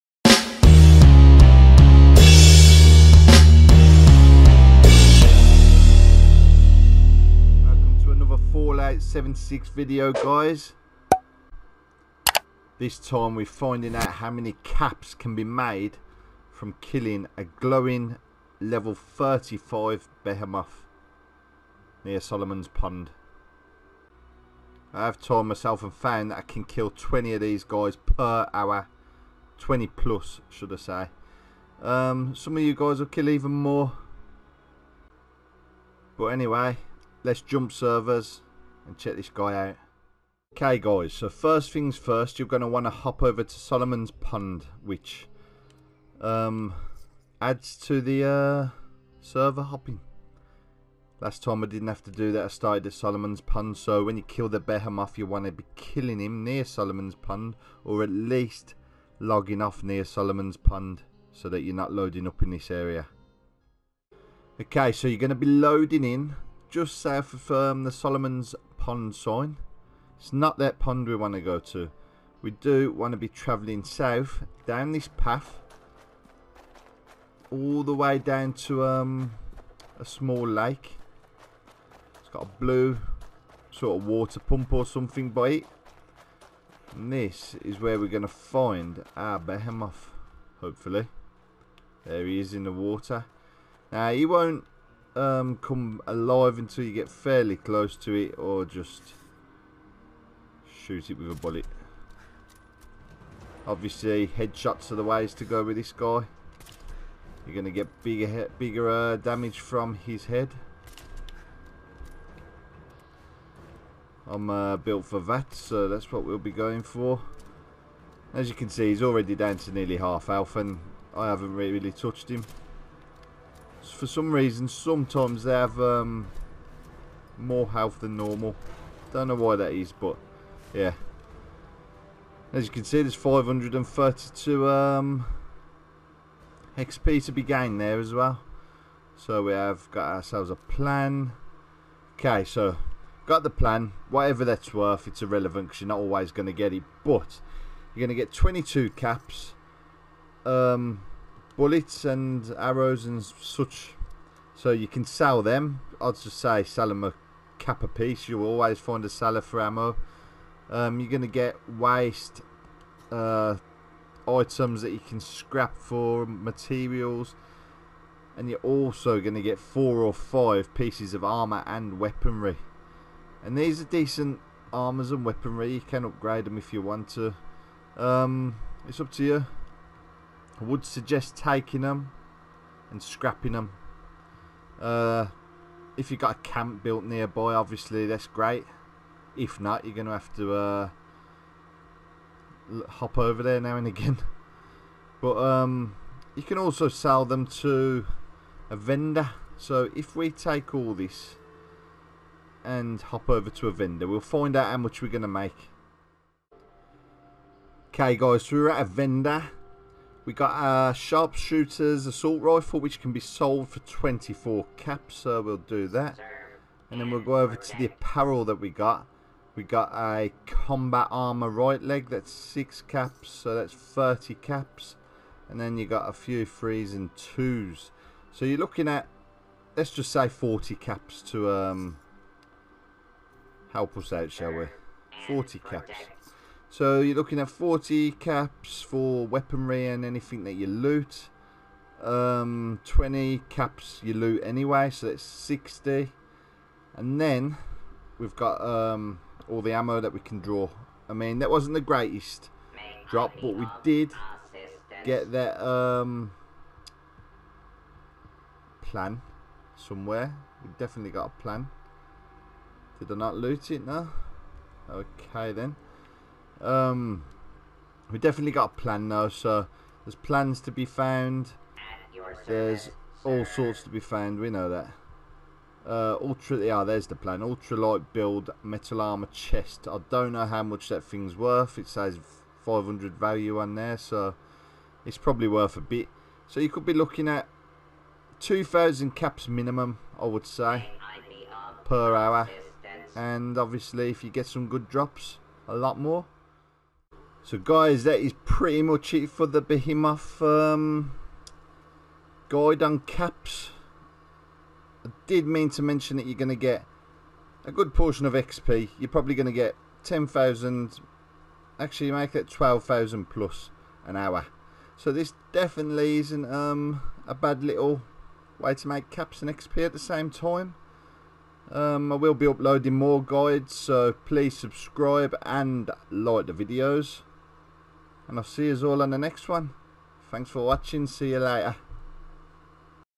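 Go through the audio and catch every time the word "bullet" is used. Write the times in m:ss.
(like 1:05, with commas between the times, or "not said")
1:41, 2:31.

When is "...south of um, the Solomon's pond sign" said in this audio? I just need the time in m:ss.
1:07.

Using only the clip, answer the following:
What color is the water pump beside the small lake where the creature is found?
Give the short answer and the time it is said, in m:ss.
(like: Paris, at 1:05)
Blue, at 1:22.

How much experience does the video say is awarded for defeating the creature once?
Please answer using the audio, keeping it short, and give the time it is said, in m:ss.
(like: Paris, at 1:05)
532, at 2:13.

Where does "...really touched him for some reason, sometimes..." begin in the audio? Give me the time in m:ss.
2:01.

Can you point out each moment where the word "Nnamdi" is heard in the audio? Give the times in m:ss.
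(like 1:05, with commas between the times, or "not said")
not said.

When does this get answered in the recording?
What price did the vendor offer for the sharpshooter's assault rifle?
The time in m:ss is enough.
3:33.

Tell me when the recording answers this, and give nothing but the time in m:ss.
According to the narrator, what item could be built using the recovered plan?
4:37.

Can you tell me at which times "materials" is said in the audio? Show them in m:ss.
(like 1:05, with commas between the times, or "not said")
2:46.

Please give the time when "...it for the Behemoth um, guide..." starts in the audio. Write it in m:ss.
4:59.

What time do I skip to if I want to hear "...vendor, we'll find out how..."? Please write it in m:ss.
3:23.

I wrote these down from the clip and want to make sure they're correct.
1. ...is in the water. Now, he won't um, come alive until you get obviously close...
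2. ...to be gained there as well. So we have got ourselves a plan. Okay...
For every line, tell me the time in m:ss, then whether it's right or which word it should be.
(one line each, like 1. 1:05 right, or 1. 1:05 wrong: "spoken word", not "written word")
1. 1:32 wrong: "fairly", not "obviously"
2. 2:17 right.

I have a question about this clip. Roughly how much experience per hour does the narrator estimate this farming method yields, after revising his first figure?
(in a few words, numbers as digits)
12,000+.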